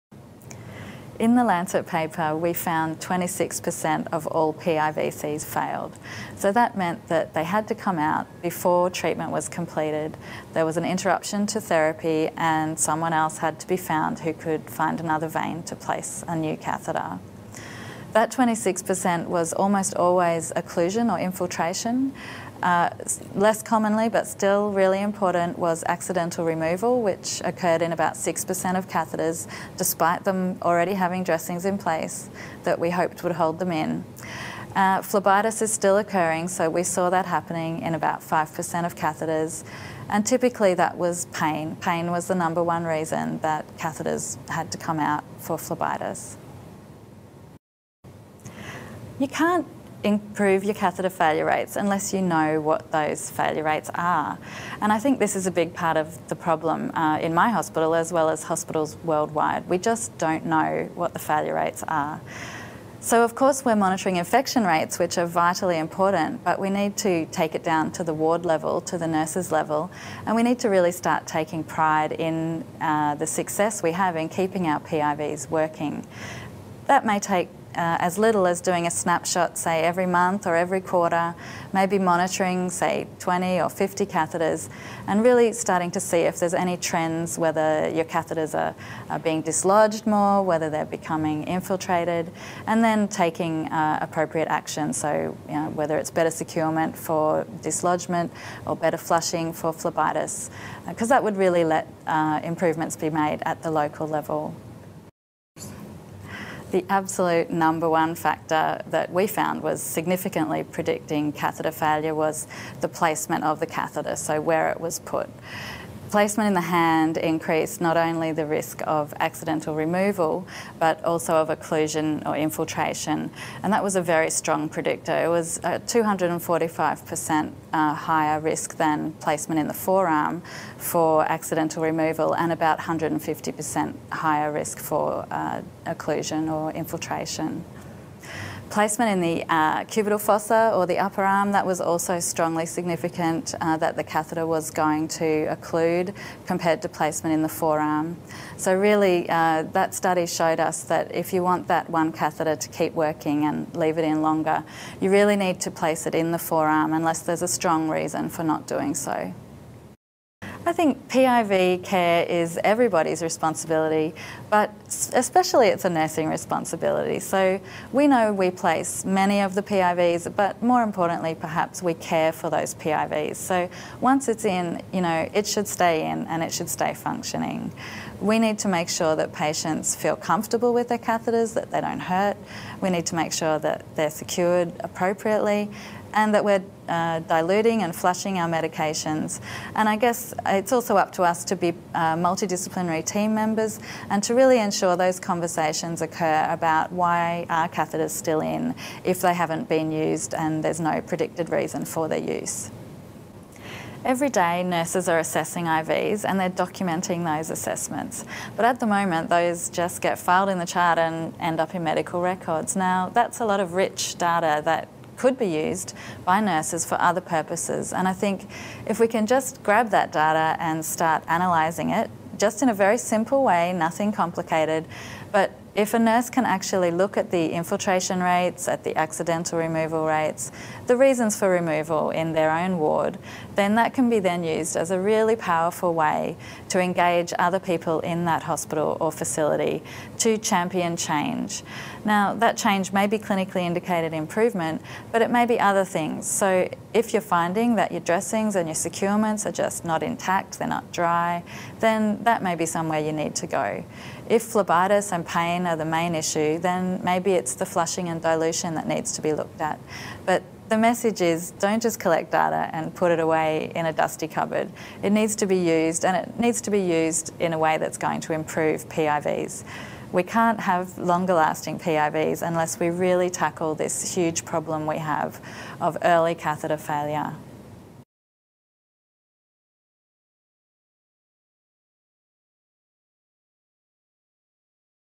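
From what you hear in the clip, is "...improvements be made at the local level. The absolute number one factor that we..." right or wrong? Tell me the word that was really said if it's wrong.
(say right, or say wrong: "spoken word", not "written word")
right.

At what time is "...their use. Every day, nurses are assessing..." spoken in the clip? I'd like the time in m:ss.
3:22.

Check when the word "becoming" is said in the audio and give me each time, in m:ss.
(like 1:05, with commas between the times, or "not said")
1:30.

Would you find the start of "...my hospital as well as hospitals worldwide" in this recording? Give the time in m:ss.
0:57.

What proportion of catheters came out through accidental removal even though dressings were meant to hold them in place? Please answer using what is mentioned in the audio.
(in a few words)
6%.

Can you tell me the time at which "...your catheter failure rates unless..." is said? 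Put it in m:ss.
0:50.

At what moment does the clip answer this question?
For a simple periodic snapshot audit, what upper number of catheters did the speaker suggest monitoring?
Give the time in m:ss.
1:23.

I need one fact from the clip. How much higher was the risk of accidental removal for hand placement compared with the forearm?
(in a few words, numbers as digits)
245%.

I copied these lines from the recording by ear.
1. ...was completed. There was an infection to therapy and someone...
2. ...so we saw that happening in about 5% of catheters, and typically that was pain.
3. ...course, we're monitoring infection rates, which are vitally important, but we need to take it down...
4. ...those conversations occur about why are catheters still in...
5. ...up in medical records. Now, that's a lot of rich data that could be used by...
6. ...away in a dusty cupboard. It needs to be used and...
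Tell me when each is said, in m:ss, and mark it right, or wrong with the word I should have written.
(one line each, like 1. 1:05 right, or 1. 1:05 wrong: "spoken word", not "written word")
1. 0:09 wrong: "interruption", not "infection"
2. 0:36 right
3. 1:03 right
4. 3:14 right
5. 3:31 right
6. 4:23 right.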